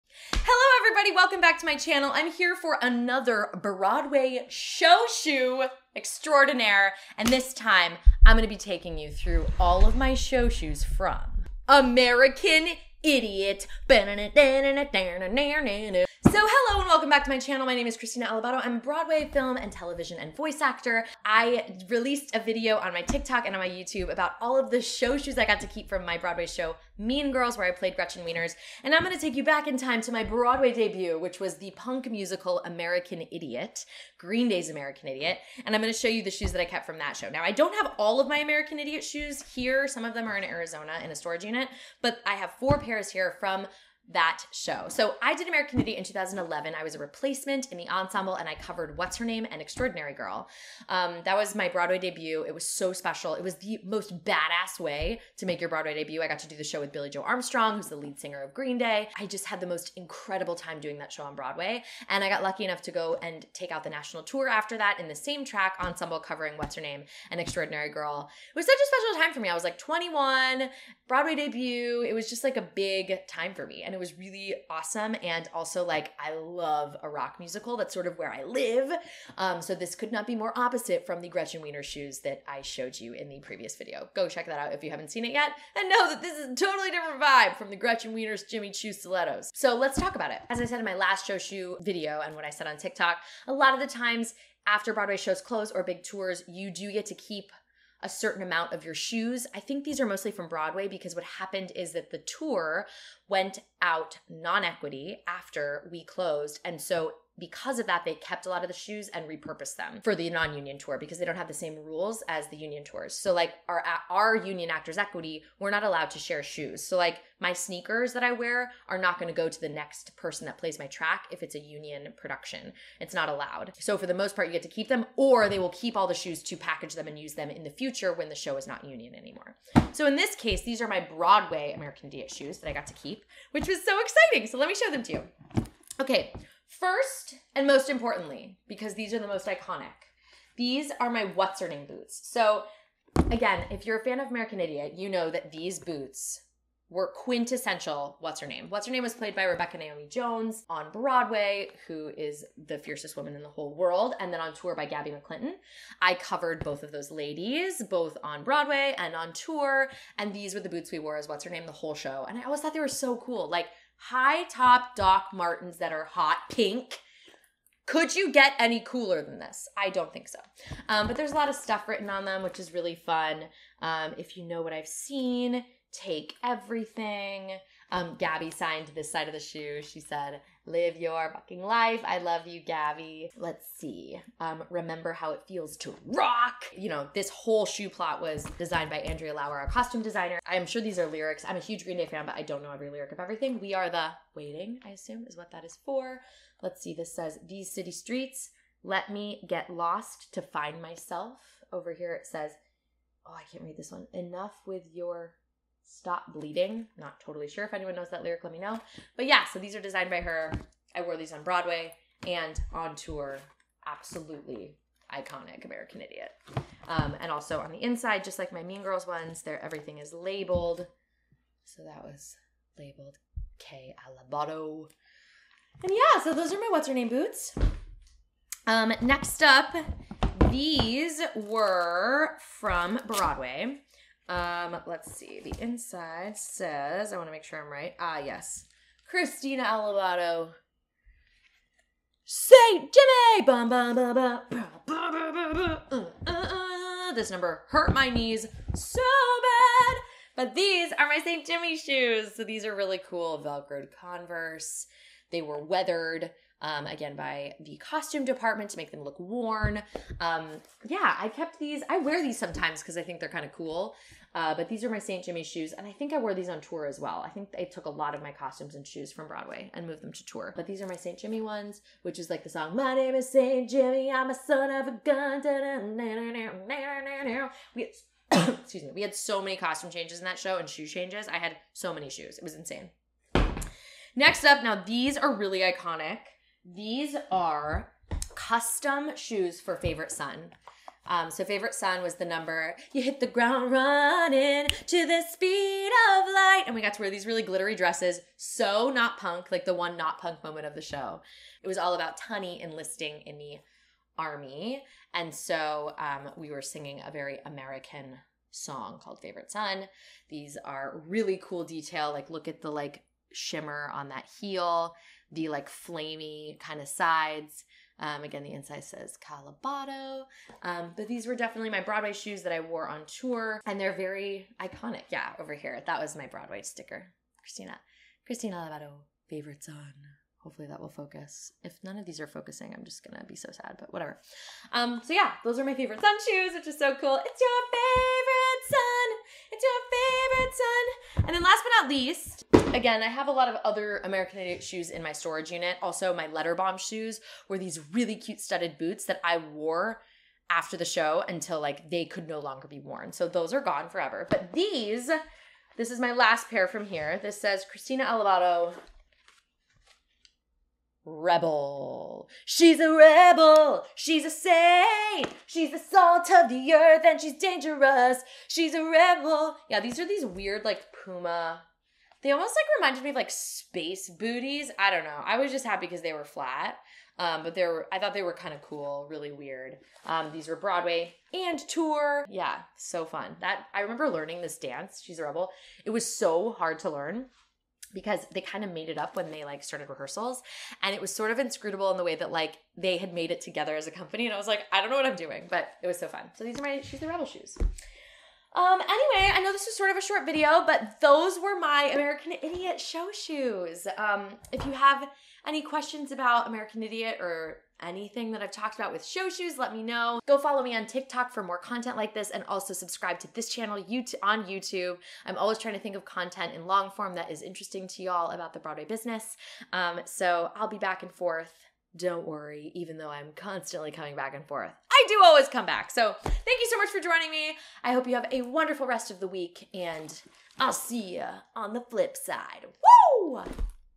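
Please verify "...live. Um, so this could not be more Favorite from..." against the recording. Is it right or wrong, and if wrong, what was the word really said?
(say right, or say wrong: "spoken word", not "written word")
wrong: "opposite", not "Favorite".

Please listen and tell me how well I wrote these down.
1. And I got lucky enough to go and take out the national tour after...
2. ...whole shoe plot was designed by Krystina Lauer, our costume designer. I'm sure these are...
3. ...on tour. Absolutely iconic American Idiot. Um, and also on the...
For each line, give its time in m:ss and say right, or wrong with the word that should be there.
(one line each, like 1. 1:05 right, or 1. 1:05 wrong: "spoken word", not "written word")
1. 1:02 right
2. 3:07 wrong: "Andrea", not "Krystina"
3. 3:32 right.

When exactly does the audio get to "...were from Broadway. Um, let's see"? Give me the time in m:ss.
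3:51.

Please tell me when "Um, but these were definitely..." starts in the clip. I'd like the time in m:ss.
5:20.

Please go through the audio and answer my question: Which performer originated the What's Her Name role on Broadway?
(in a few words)
Rebecca Naomi Jones.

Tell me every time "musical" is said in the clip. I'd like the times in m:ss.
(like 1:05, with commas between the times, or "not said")
0:32, 1:17.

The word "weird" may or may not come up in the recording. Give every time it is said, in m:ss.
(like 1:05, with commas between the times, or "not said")
6:10, 6:19.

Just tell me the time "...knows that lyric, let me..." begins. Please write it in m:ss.
3:27.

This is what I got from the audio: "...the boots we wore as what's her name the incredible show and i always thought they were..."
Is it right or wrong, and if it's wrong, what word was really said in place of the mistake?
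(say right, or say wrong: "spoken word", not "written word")
wrong: "whole", not "incredible".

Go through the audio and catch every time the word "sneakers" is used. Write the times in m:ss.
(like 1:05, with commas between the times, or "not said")
1:57.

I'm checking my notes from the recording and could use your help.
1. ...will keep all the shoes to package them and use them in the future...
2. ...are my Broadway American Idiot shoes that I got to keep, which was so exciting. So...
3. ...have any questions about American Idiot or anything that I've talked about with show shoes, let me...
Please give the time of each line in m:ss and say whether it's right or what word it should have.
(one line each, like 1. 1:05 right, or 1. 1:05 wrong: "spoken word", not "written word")
1. 2:05 right
2. 2:10 right
3. 6:44 right.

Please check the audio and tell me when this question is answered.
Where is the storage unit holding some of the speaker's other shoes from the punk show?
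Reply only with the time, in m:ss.
0:40.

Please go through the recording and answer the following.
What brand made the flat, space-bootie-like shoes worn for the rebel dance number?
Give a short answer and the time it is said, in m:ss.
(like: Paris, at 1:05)
Puma, at 6:11.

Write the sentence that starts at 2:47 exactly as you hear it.
Could you get any cooler than this?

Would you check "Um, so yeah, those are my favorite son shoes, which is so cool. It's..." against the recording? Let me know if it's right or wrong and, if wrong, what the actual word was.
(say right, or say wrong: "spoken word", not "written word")
right.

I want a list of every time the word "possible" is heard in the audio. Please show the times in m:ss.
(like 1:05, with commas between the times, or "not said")
not said.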